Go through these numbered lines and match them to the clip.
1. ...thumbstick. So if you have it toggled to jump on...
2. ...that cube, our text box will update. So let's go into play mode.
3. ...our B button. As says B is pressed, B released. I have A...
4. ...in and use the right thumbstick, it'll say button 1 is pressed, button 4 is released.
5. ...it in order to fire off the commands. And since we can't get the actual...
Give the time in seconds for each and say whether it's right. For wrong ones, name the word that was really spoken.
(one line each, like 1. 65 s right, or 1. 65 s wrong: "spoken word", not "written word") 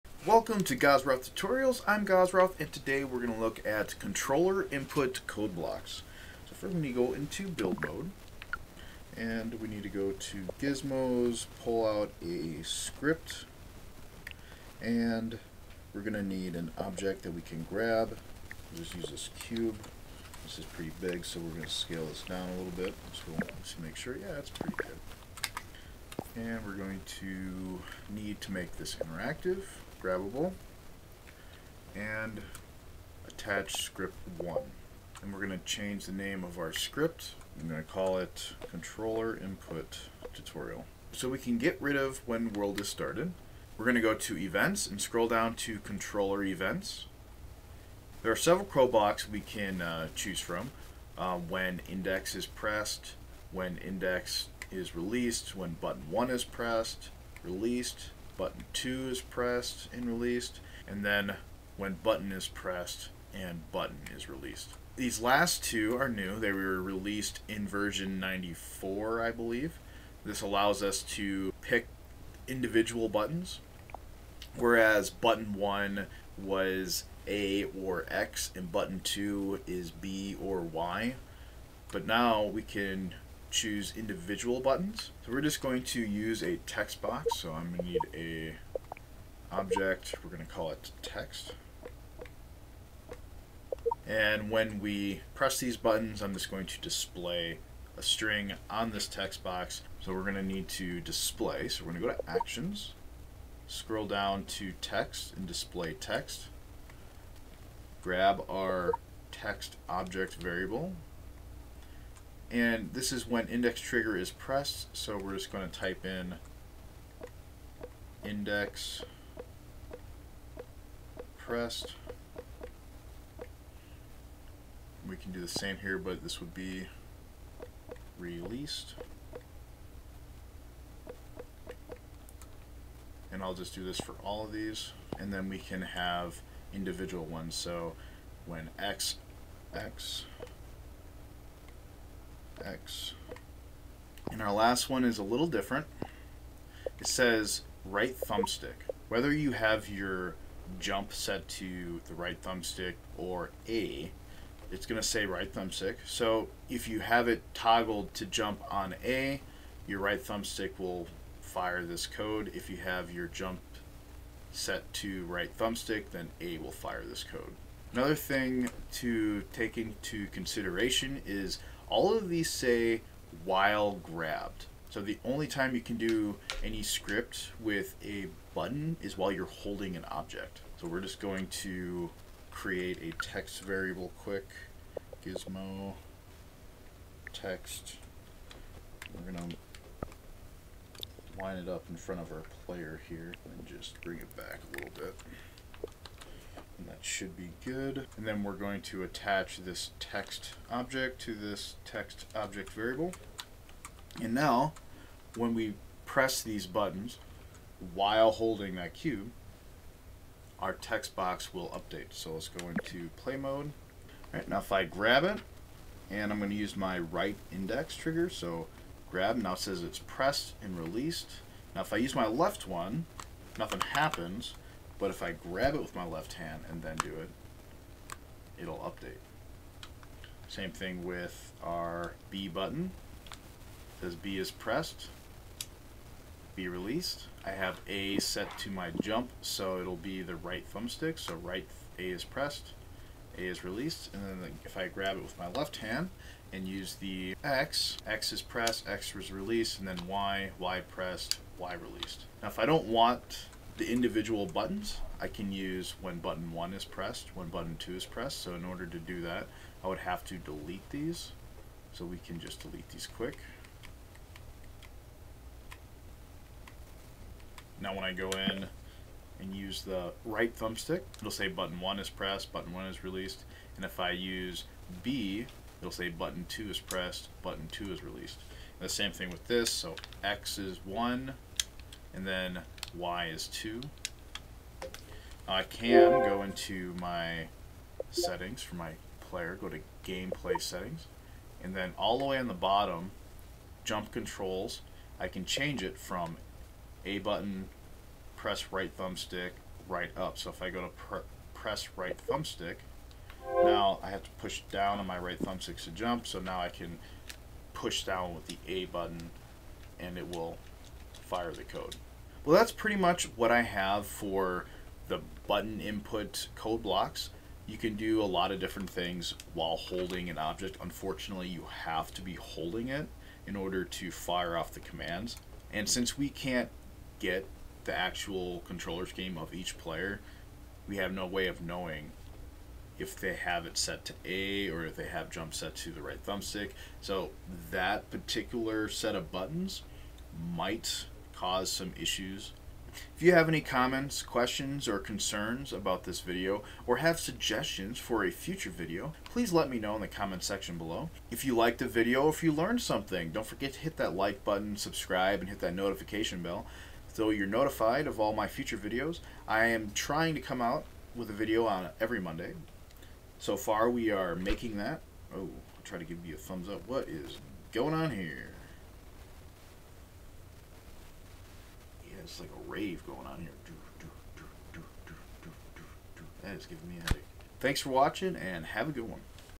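1. 155 s right
2. 208 s right
3. 231 s right
4. 268 s wrong: "1", not "4"
5. 322 s right.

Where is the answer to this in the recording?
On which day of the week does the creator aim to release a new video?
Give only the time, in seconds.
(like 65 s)
362 s.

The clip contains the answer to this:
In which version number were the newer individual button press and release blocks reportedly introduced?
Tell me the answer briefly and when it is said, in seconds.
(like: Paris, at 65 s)
94, at 68 s.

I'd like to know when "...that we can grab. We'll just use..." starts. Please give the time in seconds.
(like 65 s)
17 s.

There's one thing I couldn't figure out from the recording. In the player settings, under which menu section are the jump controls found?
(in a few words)
gameplay settings.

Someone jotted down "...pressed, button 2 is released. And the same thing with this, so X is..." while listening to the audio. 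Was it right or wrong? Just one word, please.
right.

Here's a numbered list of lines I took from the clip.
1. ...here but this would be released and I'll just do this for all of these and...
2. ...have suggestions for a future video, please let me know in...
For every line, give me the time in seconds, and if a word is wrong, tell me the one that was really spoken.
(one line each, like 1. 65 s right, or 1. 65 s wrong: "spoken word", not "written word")
1. 125 s right
2. 346 s right.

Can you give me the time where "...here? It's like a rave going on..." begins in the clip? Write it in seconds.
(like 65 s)
368 s.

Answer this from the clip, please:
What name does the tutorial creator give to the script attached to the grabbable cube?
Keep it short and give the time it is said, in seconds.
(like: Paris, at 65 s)
controller input tutorial, at 38 s.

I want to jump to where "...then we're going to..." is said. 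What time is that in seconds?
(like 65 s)
198 s.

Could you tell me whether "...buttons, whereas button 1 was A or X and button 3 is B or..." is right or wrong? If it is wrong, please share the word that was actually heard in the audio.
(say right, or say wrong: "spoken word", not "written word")
wrong: "2", not "3".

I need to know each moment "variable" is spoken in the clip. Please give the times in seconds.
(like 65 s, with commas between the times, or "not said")
110 s, 183 s, 202 s.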